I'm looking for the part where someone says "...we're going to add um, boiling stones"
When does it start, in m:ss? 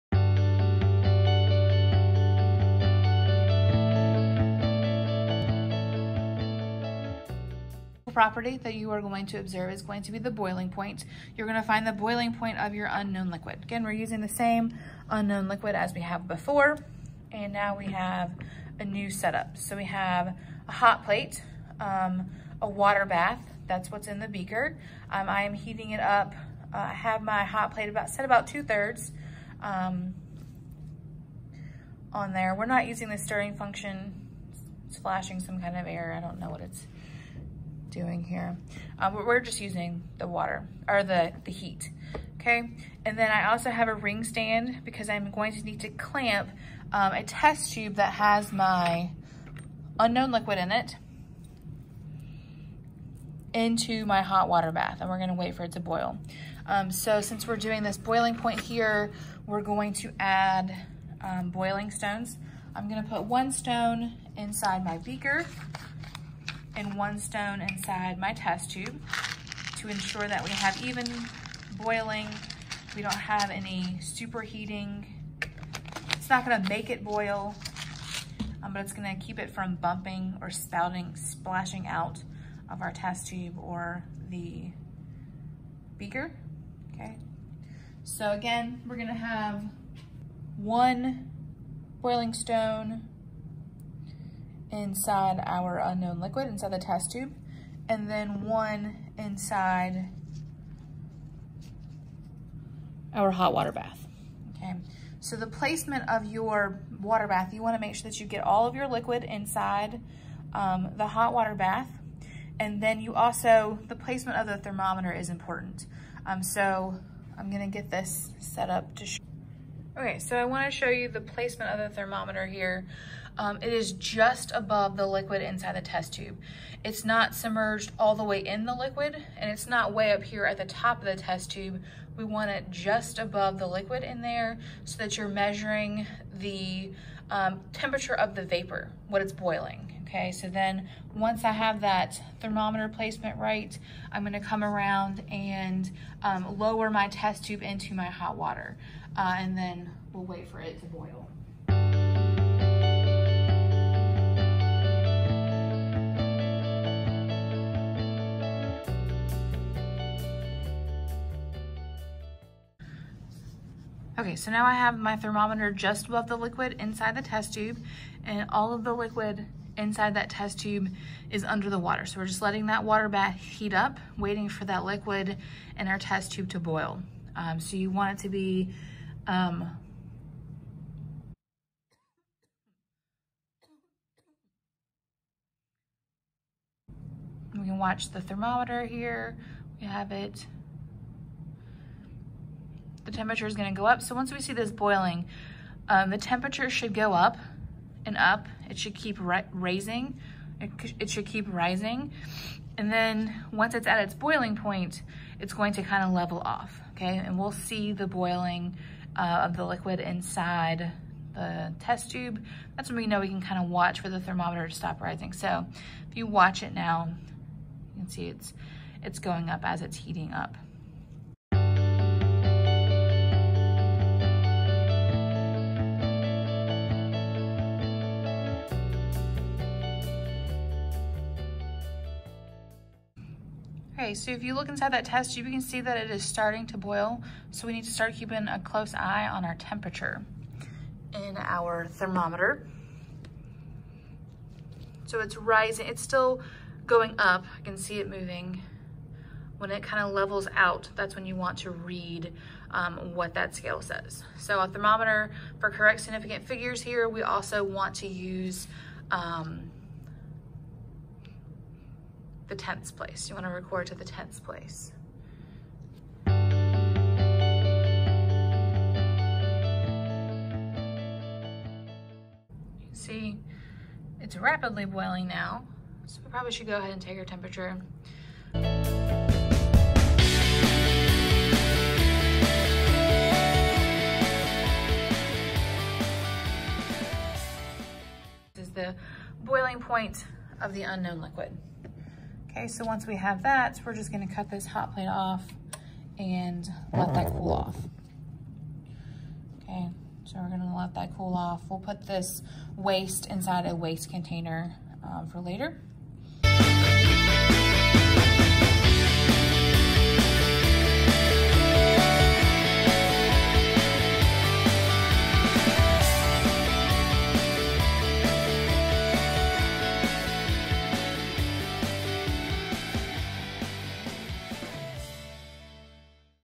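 0:59.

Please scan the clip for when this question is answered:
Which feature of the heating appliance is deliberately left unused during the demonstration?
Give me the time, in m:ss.
0:33.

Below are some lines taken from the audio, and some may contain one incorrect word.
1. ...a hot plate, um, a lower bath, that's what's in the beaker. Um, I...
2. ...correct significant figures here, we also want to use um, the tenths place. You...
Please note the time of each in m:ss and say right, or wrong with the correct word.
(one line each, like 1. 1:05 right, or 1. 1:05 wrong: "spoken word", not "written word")
1. 0:20 wrong: "water", not "lower"
2. 4:15 right.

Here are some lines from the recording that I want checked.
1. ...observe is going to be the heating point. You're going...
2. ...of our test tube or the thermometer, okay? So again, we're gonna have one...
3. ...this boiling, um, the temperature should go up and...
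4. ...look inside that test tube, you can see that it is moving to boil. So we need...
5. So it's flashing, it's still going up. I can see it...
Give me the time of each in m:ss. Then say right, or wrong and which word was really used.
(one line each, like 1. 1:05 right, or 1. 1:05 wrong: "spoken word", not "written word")
1. 0:09 wrong: "boiling", not "heating"
2. 1:22 wrong: "beaker", not "thermometer"
3. 3:14 right
4. 3:54 wrong: "starting", not "moving"
5. 4:05 wrong: "rising", not "flashing".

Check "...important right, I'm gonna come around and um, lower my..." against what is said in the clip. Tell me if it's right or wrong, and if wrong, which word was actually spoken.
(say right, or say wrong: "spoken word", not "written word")
wrong: "placement", not "important".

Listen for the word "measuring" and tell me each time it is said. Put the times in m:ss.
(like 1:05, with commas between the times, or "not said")
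2:15.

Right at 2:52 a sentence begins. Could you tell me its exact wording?
So we're just letting that water bath heat up, waiting for that liquid in our test tube to boil.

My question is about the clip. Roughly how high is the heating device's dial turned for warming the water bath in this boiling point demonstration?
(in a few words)
about two thirds.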